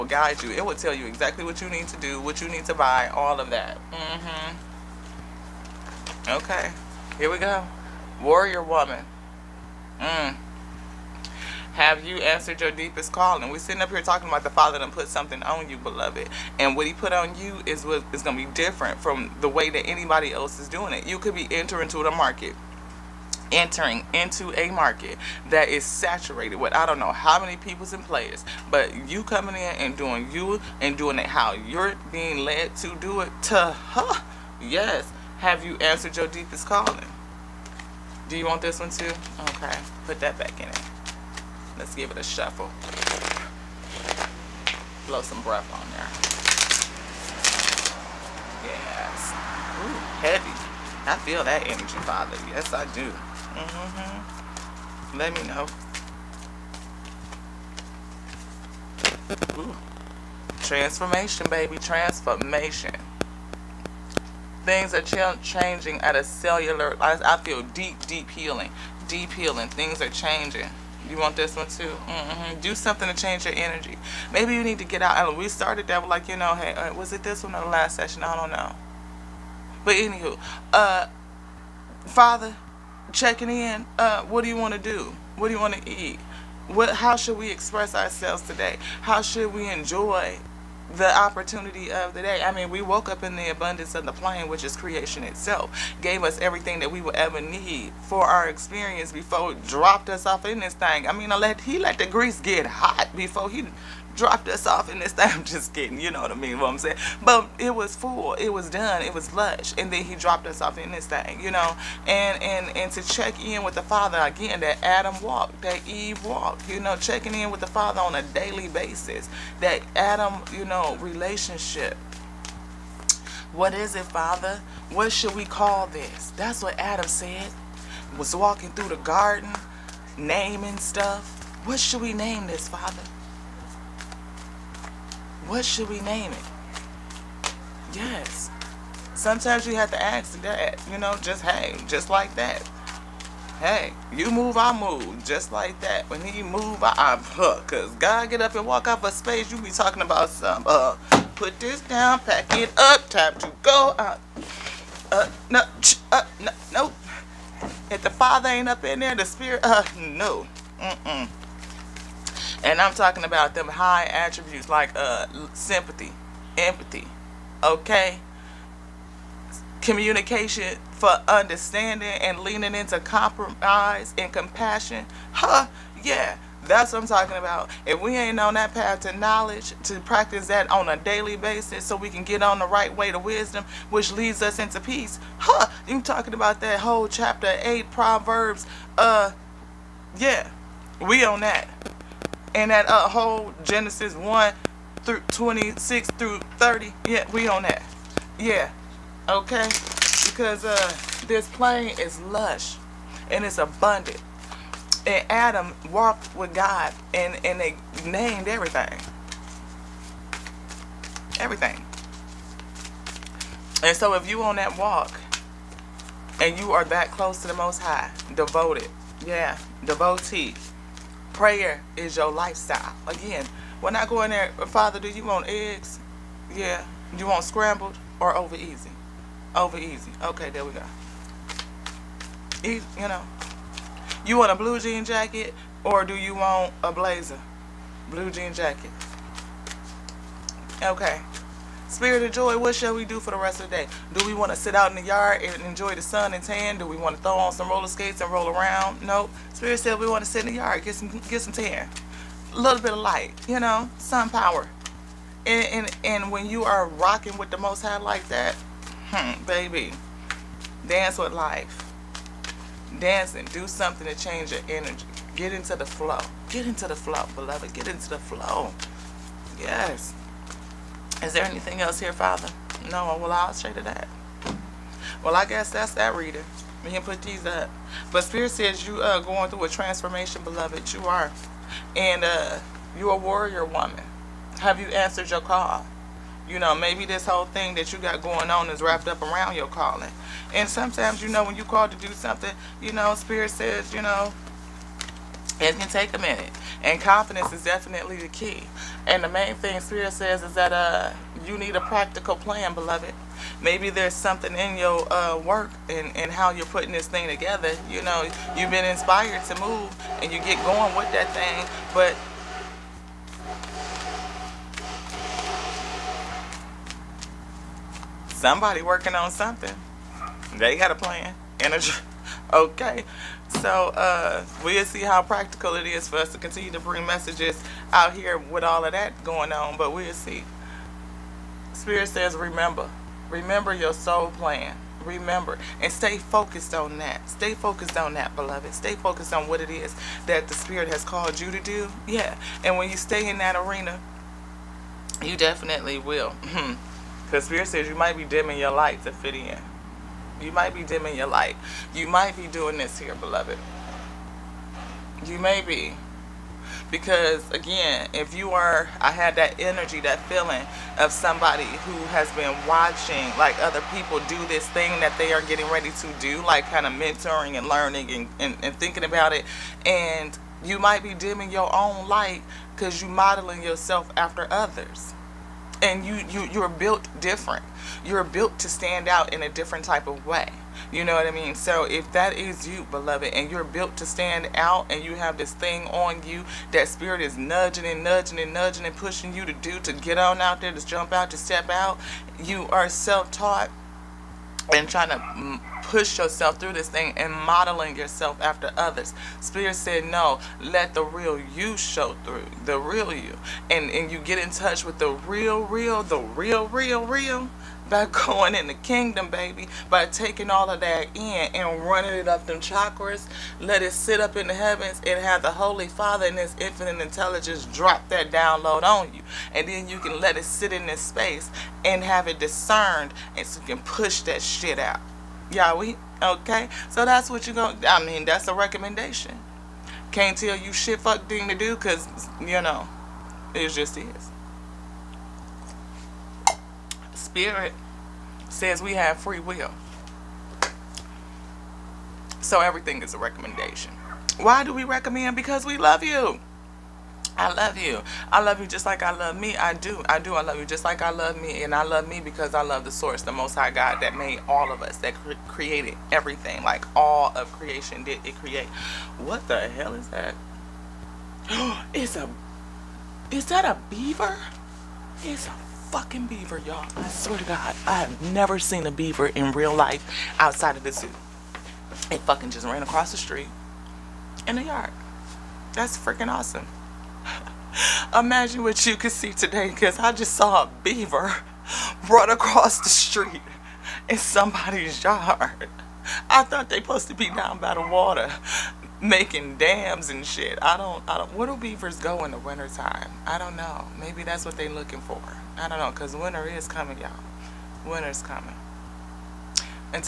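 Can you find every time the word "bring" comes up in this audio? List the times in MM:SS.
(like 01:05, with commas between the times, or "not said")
05:26.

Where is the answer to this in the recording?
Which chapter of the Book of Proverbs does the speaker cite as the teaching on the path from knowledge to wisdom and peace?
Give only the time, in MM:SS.
03:07.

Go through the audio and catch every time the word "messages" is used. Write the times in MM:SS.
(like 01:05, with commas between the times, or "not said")
05:27.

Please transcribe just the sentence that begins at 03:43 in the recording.
Again, when I go in there, Father, do you want eggs?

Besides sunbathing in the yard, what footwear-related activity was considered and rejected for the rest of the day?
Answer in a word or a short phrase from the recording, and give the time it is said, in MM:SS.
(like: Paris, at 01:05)
Roller skates, at 04:07.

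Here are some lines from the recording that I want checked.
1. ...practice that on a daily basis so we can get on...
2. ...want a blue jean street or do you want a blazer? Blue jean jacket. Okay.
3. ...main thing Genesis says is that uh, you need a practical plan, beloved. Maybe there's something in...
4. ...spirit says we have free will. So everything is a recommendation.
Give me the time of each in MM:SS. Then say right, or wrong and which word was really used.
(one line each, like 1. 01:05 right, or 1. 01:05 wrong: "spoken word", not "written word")
1. 02:59 right
2. 03:54 wrong: "jacket", not "street"
3. 04:59 wrong: "Spirit", not "Genesis"
4. 07:17 right.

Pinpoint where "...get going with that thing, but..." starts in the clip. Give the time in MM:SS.
05:10.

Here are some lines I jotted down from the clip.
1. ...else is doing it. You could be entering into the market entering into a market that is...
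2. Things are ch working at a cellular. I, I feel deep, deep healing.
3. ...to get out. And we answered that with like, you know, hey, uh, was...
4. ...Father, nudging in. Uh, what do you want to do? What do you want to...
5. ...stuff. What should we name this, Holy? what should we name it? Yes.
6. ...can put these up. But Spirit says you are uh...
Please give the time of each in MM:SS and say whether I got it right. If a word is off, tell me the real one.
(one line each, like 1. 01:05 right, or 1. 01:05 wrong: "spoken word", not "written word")
1. 00:20 right
2. 01:04 wrong: "changing", not "working"
3. 01:14 wrong: "started", not "answered"
4. 01:22 wrong: "checking", not "nudging"
5. 02:10 wrong: "Father", not "Holy"
6. 04:36 right.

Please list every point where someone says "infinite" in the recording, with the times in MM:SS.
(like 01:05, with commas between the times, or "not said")
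06:56.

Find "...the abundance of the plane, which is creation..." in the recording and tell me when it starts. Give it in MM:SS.
01:33.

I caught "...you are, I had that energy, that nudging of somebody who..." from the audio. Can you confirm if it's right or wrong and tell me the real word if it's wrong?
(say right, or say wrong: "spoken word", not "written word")
wrong: "feeling", not "nudging".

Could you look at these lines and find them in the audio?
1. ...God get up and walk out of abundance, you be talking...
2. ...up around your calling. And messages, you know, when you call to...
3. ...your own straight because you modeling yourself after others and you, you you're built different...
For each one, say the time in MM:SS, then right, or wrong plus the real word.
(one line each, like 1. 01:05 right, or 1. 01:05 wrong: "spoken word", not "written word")
1. 02:27 wrong: "space", not "abundance"
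2. 04:49 wrong: "sometimes", not "messages"
3. 06:11 wrong: "light", not "straight".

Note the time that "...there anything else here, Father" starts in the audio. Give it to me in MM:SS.
04:31.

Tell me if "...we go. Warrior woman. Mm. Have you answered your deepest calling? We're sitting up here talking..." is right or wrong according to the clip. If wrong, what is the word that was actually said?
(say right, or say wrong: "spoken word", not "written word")
right.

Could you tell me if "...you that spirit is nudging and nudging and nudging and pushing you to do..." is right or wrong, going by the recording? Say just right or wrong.
right.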